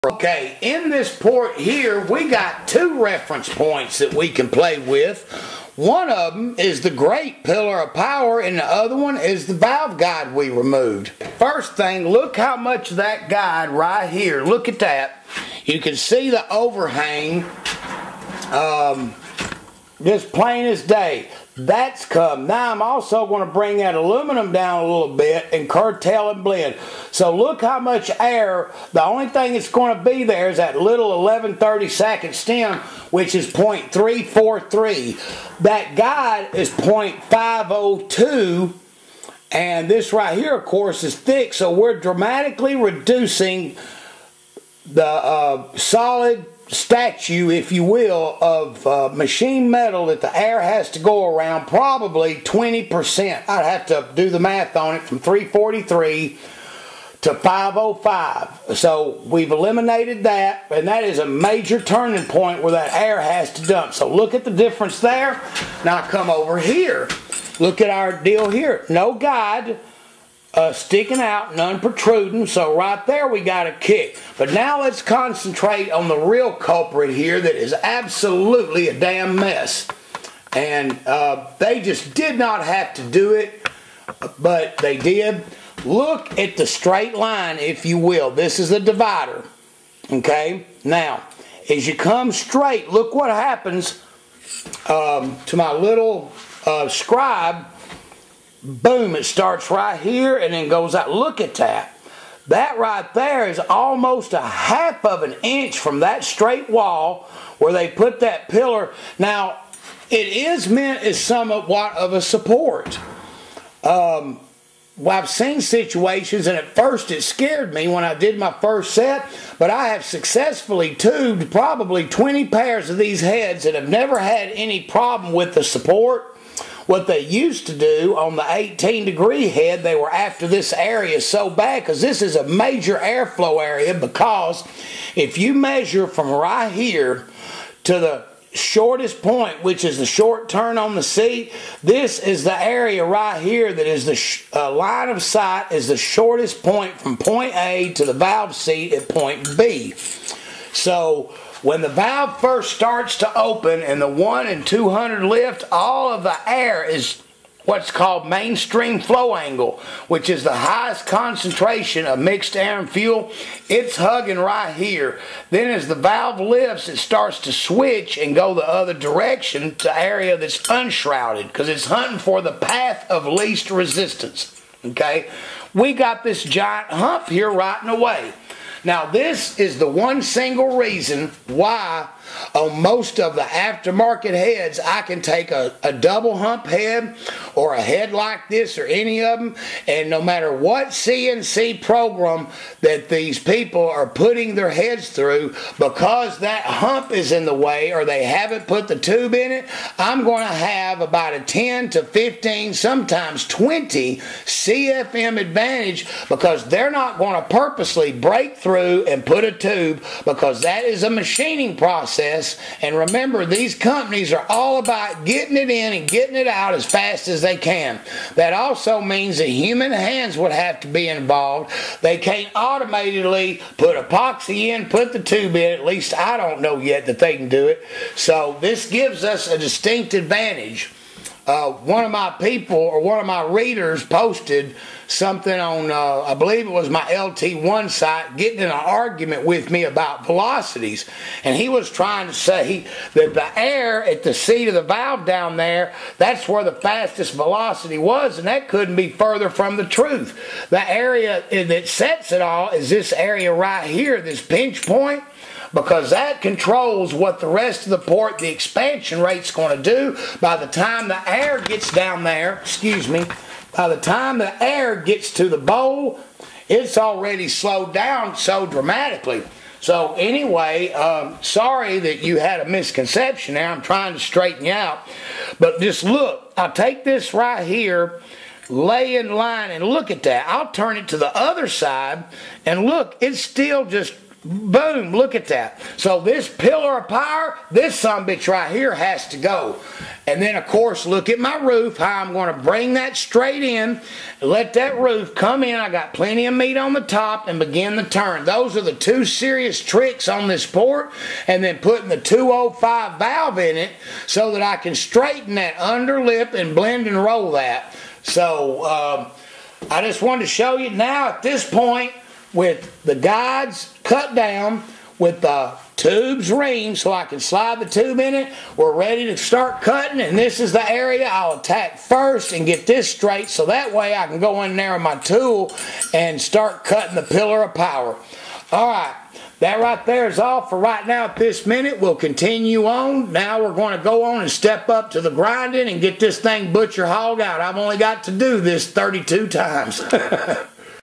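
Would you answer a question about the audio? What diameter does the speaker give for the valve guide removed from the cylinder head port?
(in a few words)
0.502.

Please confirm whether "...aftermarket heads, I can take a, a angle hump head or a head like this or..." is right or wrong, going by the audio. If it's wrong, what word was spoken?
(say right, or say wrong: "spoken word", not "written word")
wrong: "double", not "angle".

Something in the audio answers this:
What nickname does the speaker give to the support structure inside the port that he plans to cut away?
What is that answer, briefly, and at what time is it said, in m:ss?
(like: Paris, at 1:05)
great pillar of power, at 0:06.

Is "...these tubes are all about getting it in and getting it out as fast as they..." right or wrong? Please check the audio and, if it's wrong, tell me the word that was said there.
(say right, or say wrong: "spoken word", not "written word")
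wrong: "companies", not "tubes".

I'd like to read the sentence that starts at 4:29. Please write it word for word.
So anyway, um, sorry that you had a misconception there.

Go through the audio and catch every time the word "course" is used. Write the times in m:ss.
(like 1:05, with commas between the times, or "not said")
0:40, 4:50.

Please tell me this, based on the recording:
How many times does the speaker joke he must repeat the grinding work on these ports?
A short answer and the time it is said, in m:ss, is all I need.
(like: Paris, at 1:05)
32, at 5:38.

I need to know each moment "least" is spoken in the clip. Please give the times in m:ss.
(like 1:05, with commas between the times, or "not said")
2:53, 3:45.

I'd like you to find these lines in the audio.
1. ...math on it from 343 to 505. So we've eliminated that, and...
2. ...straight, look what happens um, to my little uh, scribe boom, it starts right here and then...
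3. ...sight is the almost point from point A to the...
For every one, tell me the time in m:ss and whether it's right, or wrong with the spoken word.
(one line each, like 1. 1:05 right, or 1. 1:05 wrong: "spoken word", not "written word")
1. 0:54 right
2. 1:32 right
3. 2:25 wrong: "shortest", not "almost".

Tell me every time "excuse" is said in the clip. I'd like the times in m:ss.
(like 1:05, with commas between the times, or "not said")
4:22.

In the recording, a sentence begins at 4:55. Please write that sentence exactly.
I got plenty of meat on the top and begin the turn.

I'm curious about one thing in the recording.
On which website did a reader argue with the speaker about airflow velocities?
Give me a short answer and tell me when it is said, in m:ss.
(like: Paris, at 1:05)
LT1 site, at 3:57.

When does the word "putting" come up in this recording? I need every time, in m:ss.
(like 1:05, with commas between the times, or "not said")
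3:14, 5:01.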